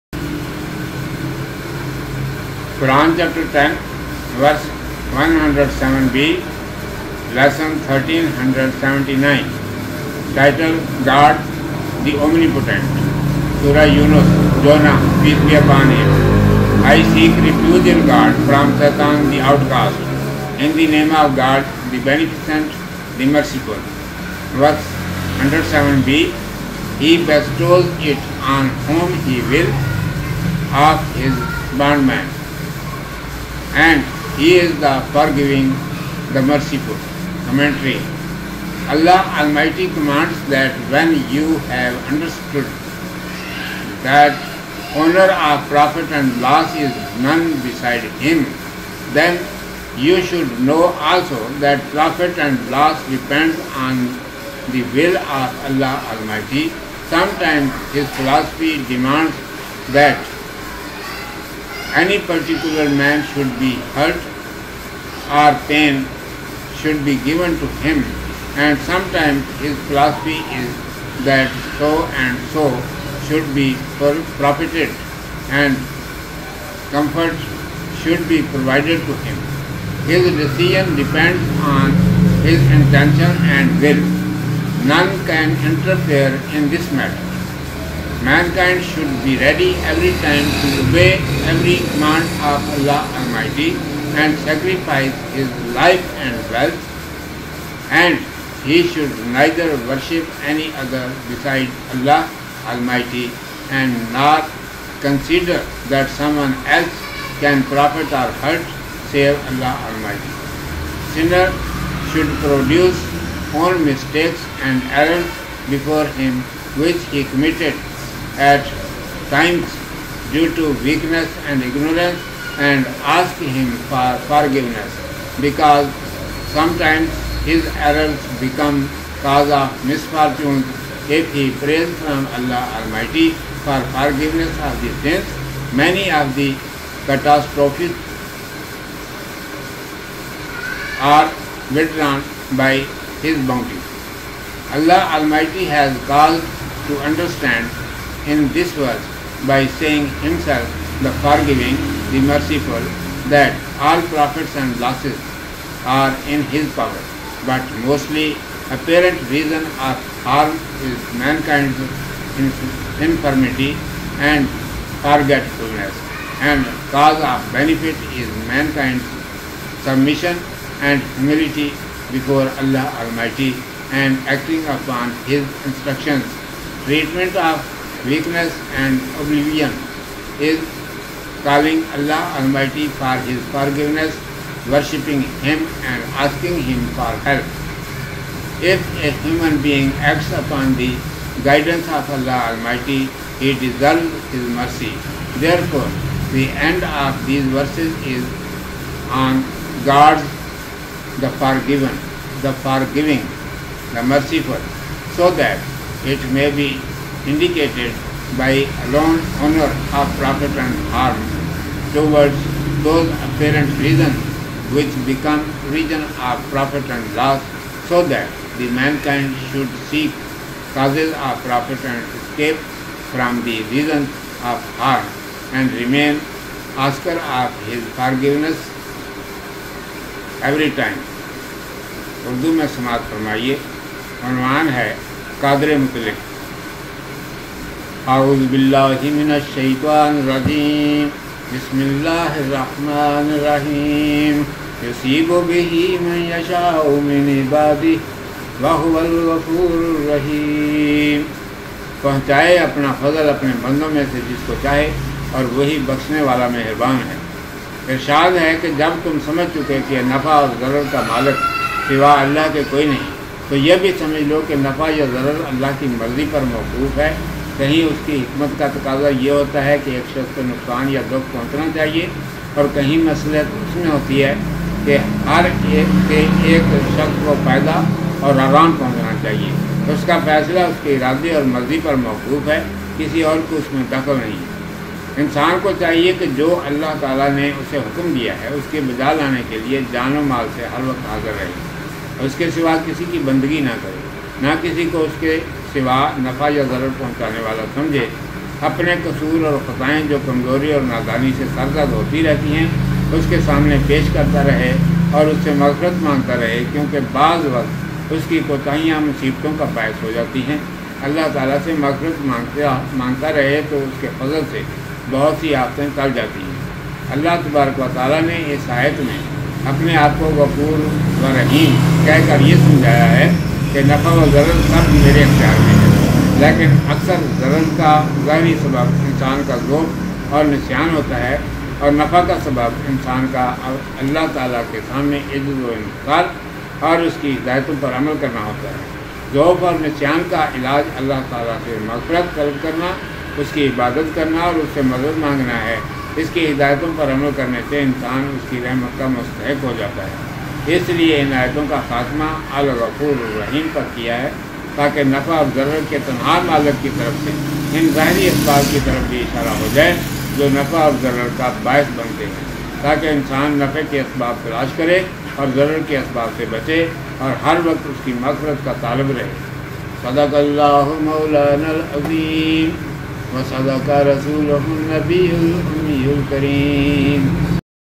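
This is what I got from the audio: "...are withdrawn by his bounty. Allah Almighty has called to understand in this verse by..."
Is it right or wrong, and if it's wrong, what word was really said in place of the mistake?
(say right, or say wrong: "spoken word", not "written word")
right.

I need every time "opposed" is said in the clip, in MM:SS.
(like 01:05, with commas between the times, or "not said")
not said.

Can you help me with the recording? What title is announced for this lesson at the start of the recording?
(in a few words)
God the Omnipotent.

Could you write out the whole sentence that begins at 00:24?
Verse 107b, He bestows it on whom He will of His bondman and He is the forgiving, the merciful.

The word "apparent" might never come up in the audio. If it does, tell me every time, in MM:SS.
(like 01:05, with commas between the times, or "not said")
02:38, 03:33.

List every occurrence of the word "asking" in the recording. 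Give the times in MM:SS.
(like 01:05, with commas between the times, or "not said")
03:06.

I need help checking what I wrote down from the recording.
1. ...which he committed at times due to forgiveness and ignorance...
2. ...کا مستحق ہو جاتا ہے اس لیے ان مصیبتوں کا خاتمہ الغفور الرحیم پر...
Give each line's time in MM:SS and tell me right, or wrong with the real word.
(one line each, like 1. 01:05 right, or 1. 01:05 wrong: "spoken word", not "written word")
1. 01:56 wrong: "weakness", not "forgiveness"
2. 05:48 wrong: "آیتوں", not "مصیبتوں".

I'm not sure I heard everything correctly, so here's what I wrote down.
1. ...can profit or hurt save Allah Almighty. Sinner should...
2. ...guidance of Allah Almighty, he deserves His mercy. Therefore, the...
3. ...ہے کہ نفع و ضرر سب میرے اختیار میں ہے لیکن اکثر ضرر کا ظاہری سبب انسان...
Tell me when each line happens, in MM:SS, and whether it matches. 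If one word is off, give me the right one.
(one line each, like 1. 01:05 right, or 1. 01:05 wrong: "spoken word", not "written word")
1. 01:47 right
2. 03:11 right
3. 05:23 right.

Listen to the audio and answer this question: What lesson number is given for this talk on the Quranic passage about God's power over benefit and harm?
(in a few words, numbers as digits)
1379.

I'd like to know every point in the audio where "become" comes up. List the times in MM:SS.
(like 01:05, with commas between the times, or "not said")
02:08, 03:35.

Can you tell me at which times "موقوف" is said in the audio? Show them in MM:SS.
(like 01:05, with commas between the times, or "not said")
04:26, 04:42.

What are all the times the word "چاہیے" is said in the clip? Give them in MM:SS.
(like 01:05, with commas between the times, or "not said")
04:31, 04:39, 04:45.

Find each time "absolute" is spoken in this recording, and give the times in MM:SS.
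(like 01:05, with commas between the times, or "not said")
not said.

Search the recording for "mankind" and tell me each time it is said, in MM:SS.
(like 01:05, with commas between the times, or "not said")
01:28, 02:41, 02:48, 03:38.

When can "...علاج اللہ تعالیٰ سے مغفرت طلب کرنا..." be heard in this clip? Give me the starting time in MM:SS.
05:40.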